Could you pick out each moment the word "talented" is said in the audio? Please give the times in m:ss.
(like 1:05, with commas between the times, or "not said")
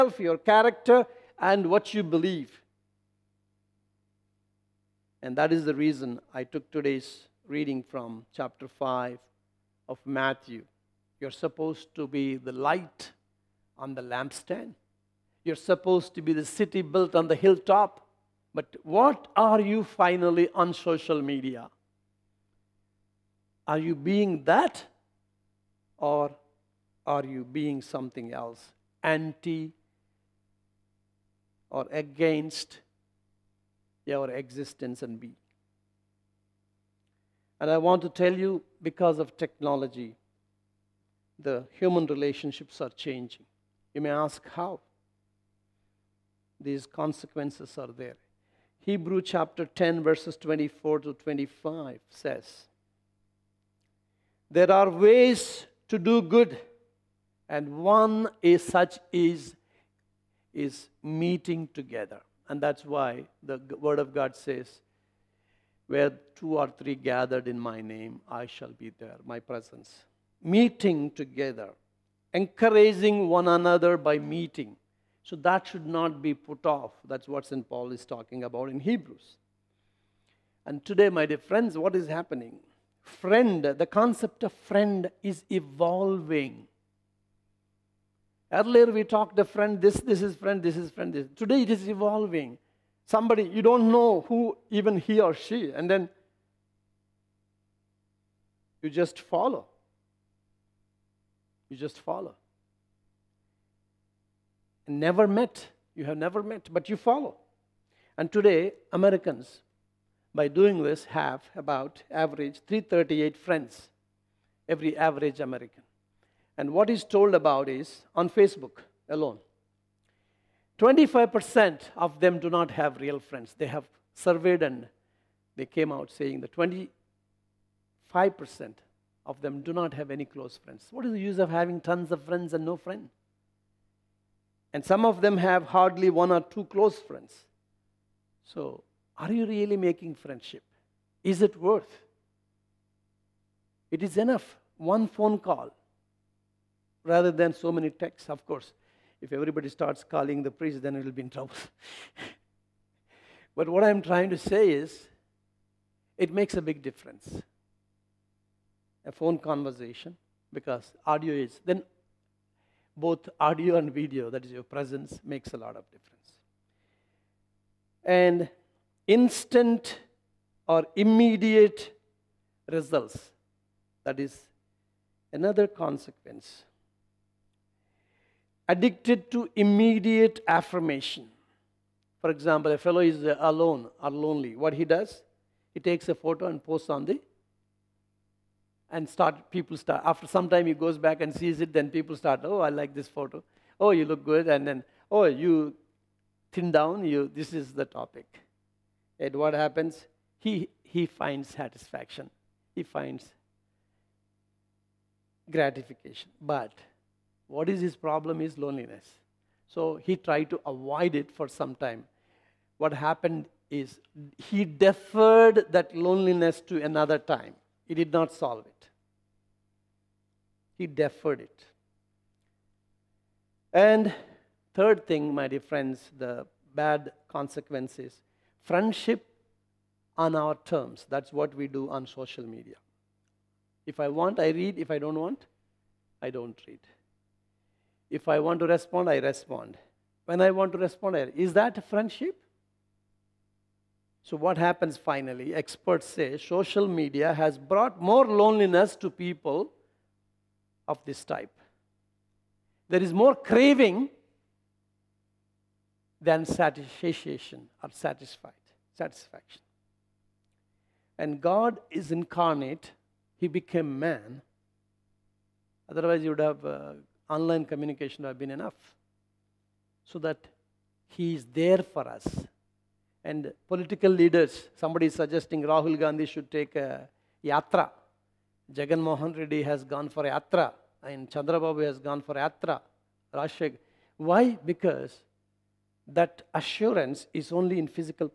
not said.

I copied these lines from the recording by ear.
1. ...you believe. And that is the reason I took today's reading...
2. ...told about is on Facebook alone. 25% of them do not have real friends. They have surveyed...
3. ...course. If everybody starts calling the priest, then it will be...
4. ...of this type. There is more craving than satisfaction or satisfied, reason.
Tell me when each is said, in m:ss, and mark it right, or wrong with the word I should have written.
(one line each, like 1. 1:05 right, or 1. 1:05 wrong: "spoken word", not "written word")
1. 0:01 right
2. 1:57 right
3. 2:28 right
4. 4:10 wrong: "satisfaction", not "reason".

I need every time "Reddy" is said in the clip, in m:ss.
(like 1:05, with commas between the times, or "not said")
4:39.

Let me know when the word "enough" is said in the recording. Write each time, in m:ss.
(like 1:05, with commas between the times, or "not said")
2:24, 4:28.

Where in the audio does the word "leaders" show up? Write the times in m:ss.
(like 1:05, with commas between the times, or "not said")
4:34.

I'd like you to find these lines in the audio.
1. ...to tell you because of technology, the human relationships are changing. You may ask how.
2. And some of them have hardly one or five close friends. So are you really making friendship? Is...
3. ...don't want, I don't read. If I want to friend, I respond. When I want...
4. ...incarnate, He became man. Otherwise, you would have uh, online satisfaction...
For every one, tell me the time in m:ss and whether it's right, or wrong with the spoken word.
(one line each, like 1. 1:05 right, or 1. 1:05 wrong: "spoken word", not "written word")
1. 0:38 right
2. 2:14 wrong: "two", not "five"
3. 3:54 wrong: "respond", not "friend"
4. 4:22 wrong: "communication", not "satisfaction".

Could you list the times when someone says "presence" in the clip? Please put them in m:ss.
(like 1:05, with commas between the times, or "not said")
1:09, 2:44.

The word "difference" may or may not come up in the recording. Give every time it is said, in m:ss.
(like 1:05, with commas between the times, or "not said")
2:36, 2:45.